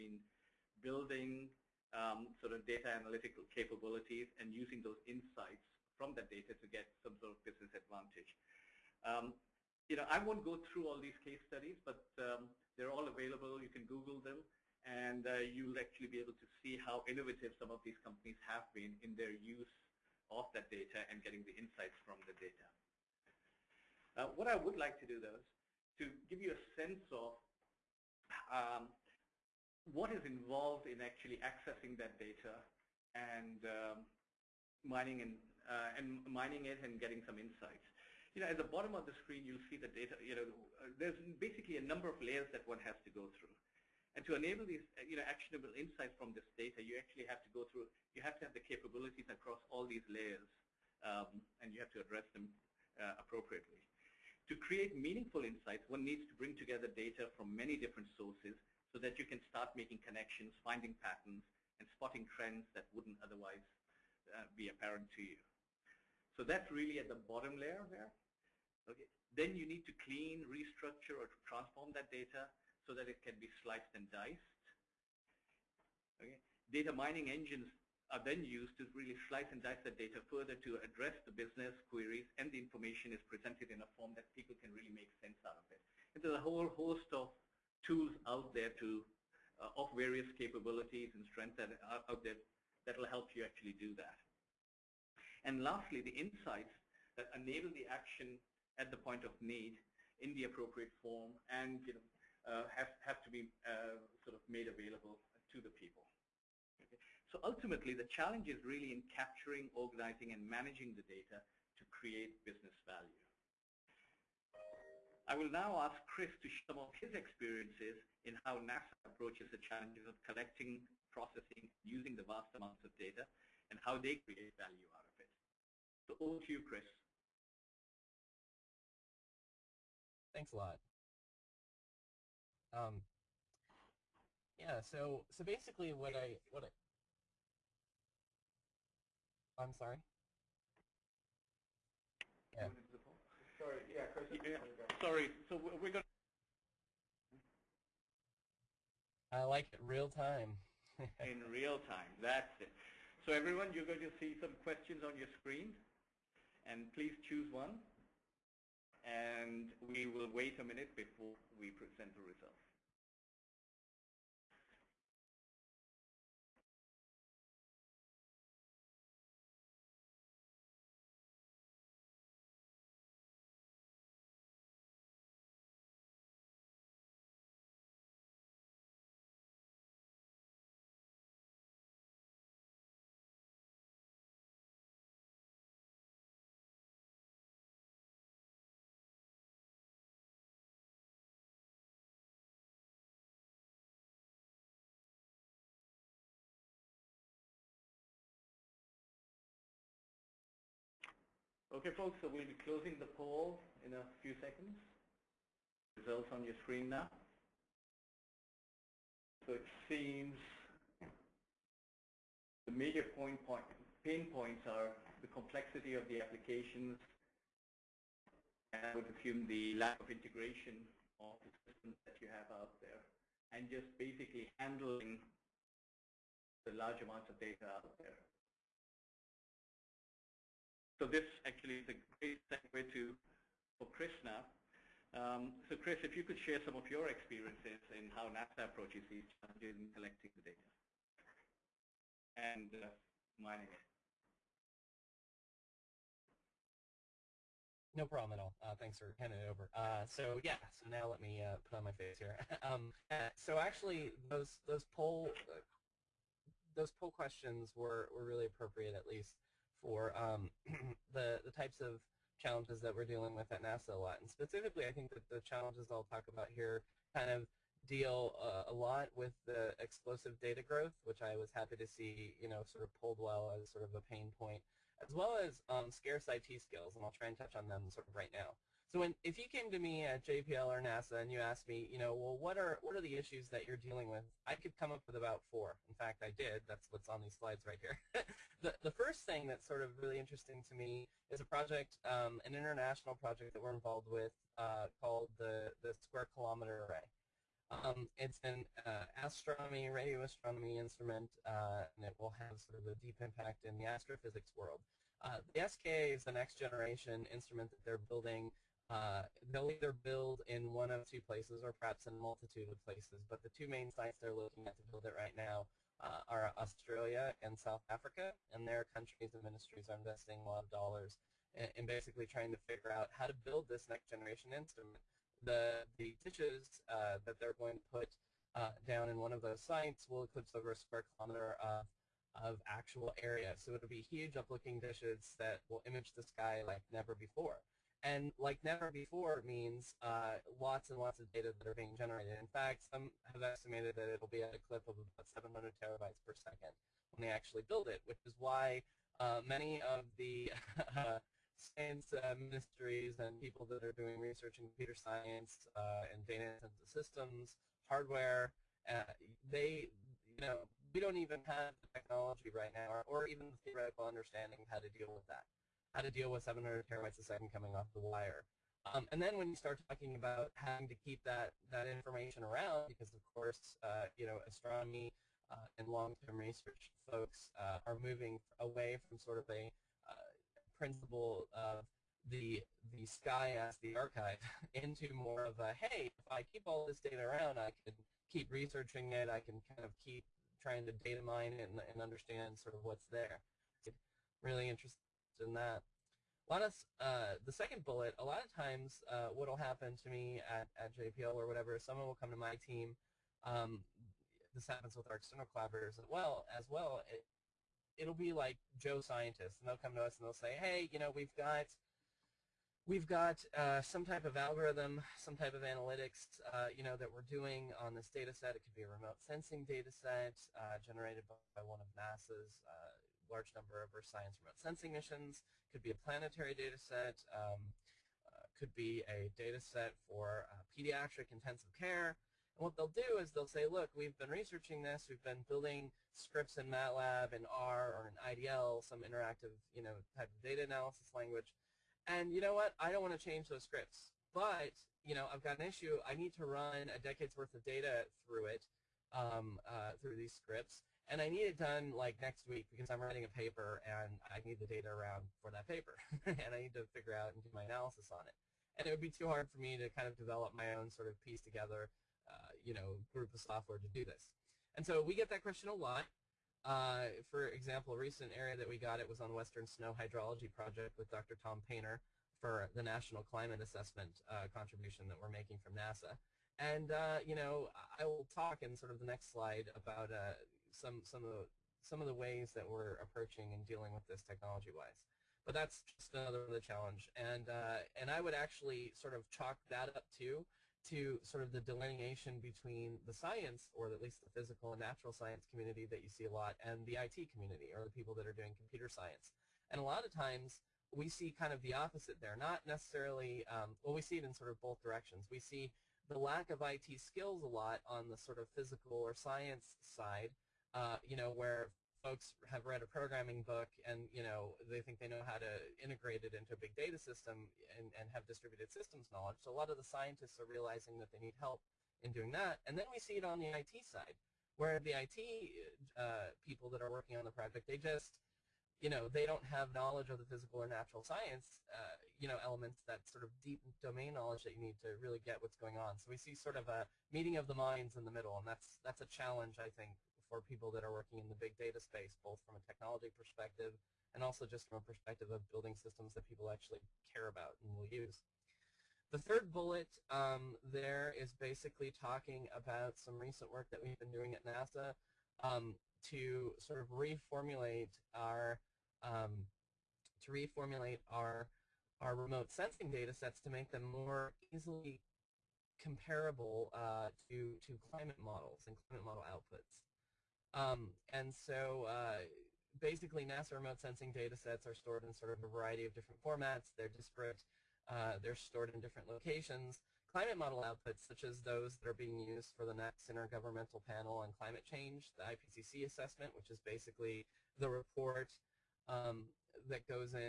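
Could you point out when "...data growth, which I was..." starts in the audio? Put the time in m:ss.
4:30.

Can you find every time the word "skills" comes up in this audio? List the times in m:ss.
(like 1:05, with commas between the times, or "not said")
4:36, 8:26.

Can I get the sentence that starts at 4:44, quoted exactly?
I could come up with about four.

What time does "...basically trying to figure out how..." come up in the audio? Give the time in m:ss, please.
5:21.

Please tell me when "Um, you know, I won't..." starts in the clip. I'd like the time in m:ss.
0:09.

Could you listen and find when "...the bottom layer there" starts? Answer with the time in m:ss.
1:07.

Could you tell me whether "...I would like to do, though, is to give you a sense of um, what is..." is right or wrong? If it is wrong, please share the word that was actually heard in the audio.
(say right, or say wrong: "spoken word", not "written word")
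right.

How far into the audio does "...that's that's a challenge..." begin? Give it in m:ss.
8:58.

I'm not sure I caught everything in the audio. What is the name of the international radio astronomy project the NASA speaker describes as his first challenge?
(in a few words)
Square Kilometer Array.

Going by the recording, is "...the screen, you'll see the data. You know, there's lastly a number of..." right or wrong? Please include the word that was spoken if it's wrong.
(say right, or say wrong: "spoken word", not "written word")
wrong: "basically", not "lastly".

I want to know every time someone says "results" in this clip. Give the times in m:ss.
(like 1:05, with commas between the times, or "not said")
2:42, 3:25.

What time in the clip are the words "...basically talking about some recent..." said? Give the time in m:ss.
9:11.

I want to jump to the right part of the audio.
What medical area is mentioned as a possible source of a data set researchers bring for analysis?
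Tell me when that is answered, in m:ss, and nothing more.
7:10.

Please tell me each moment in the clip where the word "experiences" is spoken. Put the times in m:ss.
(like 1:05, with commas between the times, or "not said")
1:57, 3:57.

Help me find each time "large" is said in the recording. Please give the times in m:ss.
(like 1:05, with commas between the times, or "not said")
3:46, 7:03.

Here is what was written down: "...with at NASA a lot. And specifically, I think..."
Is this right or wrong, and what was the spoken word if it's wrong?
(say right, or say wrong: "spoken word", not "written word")
right.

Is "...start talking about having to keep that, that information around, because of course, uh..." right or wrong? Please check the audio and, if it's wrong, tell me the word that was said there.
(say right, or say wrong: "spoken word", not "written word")
right.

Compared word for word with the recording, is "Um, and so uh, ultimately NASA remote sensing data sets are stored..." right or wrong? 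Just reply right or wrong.
wrong.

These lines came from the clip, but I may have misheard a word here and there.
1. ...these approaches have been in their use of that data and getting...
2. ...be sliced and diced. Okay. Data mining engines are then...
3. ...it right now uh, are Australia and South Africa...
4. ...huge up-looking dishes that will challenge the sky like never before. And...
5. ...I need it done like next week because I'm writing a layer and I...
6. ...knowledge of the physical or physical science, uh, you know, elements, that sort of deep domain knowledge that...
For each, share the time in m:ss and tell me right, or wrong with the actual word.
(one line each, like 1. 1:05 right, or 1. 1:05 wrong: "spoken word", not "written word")
1. 0:17 wrong: "companies", not "approaches"
2. 1:13 right
3. 5:15 right
4. 5:34 wrong: "image", not "challenge"
5. 7:31 wrong: "paper", not "layer"
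6. 8:49 wrong: "natural", not "physical".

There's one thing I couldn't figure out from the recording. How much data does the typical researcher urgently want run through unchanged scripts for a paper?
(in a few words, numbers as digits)
a decade's worth.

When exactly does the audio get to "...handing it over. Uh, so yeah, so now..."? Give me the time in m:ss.
4:09.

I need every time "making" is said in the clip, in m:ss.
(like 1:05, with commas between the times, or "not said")
0:59, 7:55.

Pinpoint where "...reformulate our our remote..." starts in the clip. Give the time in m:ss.
9:20.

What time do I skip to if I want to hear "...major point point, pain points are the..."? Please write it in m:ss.
3:32.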